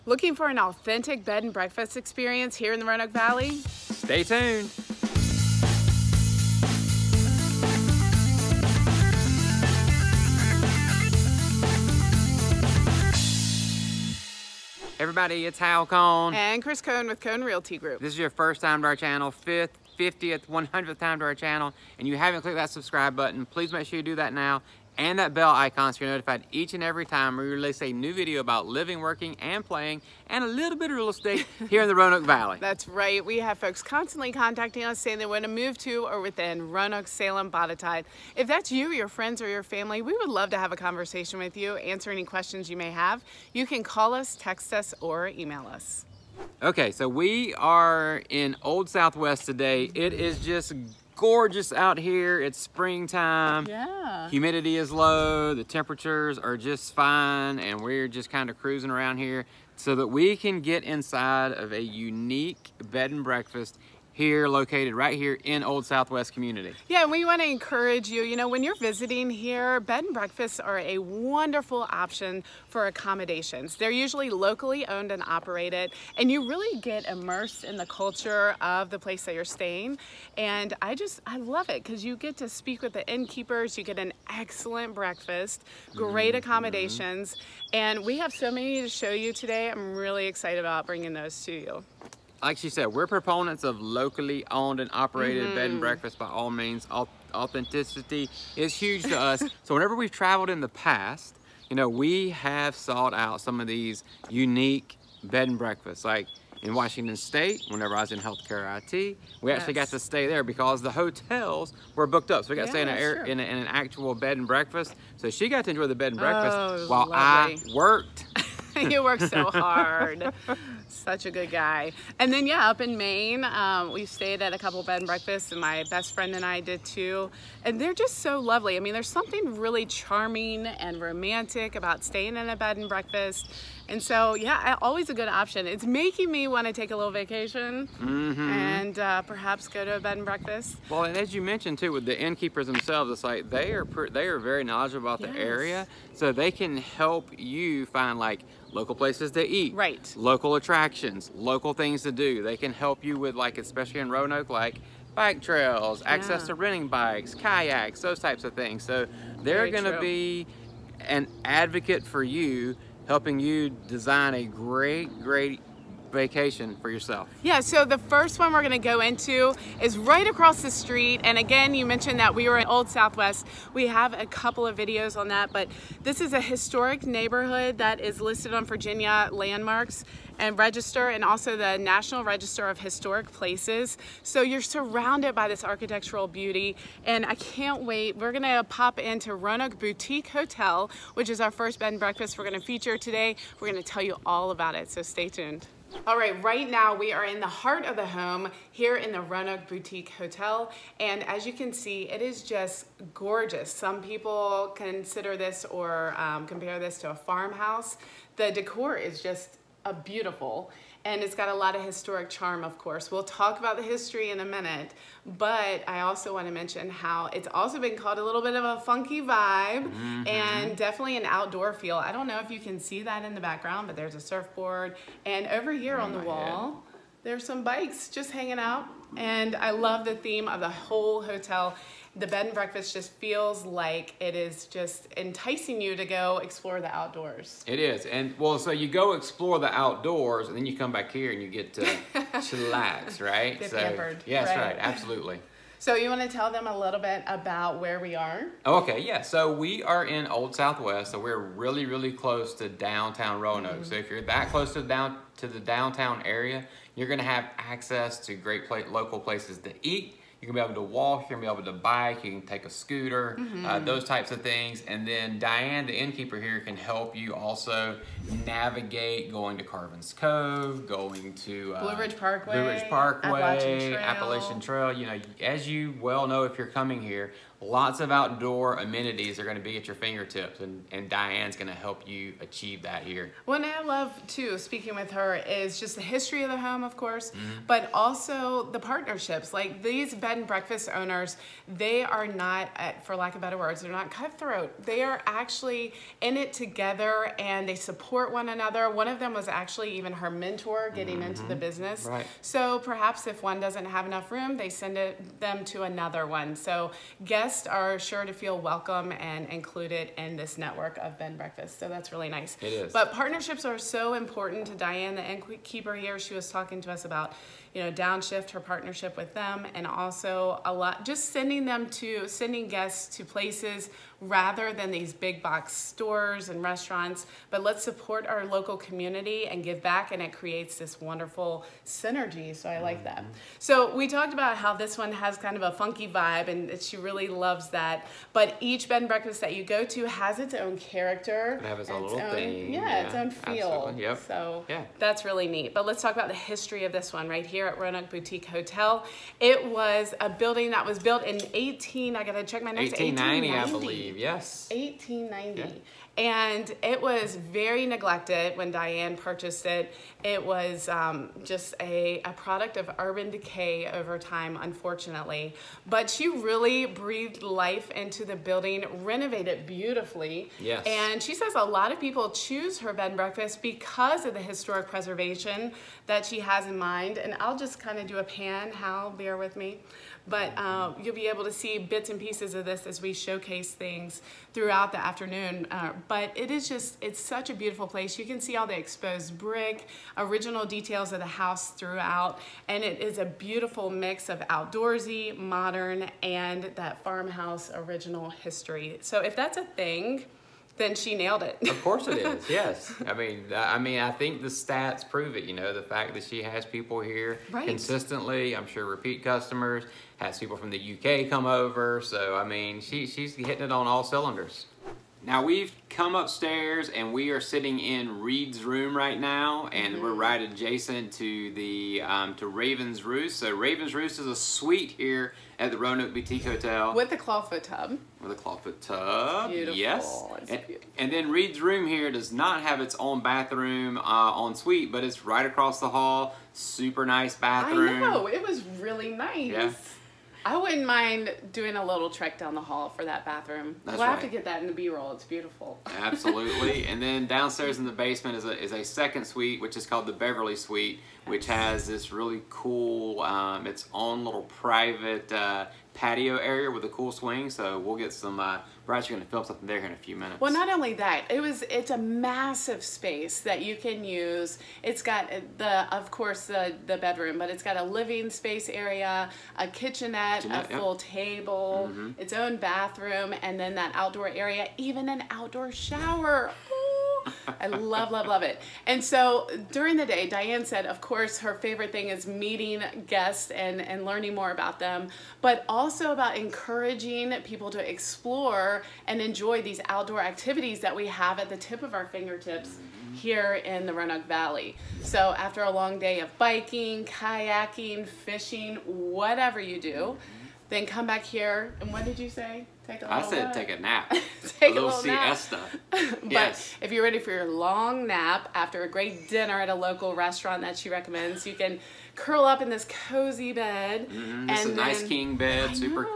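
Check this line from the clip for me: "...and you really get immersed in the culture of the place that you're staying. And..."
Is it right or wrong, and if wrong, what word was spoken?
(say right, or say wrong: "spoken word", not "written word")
right.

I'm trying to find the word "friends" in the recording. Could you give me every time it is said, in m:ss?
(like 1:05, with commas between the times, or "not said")
0:39, 2:06.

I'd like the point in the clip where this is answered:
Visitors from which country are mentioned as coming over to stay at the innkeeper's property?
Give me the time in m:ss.
6:50.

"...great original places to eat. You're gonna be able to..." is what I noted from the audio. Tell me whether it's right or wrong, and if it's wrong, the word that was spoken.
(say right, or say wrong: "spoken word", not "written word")
wrong: "local", not "original".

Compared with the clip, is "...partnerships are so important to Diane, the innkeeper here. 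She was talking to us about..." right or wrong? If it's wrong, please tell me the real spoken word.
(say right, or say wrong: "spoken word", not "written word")
right.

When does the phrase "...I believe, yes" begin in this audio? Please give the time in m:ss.
5:53.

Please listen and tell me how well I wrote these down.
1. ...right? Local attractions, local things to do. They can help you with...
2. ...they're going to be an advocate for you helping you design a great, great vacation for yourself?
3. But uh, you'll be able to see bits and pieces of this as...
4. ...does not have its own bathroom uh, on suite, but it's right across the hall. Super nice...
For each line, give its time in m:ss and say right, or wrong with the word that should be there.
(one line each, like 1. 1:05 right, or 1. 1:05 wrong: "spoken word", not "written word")
1. 2:29 right
2. 2:39 right
3. 6:20 right
4. 7:12 right.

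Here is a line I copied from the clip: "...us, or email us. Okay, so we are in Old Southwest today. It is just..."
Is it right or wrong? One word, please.
right.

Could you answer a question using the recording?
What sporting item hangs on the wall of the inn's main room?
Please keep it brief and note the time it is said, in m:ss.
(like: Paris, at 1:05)
a surfboard, at 3:44.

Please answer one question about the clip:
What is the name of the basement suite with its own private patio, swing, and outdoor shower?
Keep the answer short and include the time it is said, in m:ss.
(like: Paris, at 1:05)
Beverly Suite, at 7:30.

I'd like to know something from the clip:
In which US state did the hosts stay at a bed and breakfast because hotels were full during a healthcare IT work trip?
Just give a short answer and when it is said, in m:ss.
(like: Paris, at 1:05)
Washington State, at 1:46.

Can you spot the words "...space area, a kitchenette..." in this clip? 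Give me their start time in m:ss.
7:48.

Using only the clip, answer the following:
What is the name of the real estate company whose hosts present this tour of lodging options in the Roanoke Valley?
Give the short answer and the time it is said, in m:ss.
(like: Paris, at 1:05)
Cone Realty Group, at 0:17.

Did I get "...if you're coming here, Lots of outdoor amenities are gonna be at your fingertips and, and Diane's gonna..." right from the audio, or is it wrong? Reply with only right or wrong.
right.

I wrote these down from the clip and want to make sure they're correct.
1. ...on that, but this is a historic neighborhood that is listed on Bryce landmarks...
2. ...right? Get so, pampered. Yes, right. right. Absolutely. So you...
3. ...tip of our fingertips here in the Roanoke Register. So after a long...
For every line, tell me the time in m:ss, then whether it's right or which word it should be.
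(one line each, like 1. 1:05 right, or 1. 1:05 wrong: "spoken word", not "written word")
1. 2:55 wrong: "Virginia", not "Bryce"
2. 4:03 right
3. 8:11 wrong: "Valley", not "Register".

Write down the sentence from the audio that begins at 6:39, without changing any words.
So if that's a thing, then she nailed it.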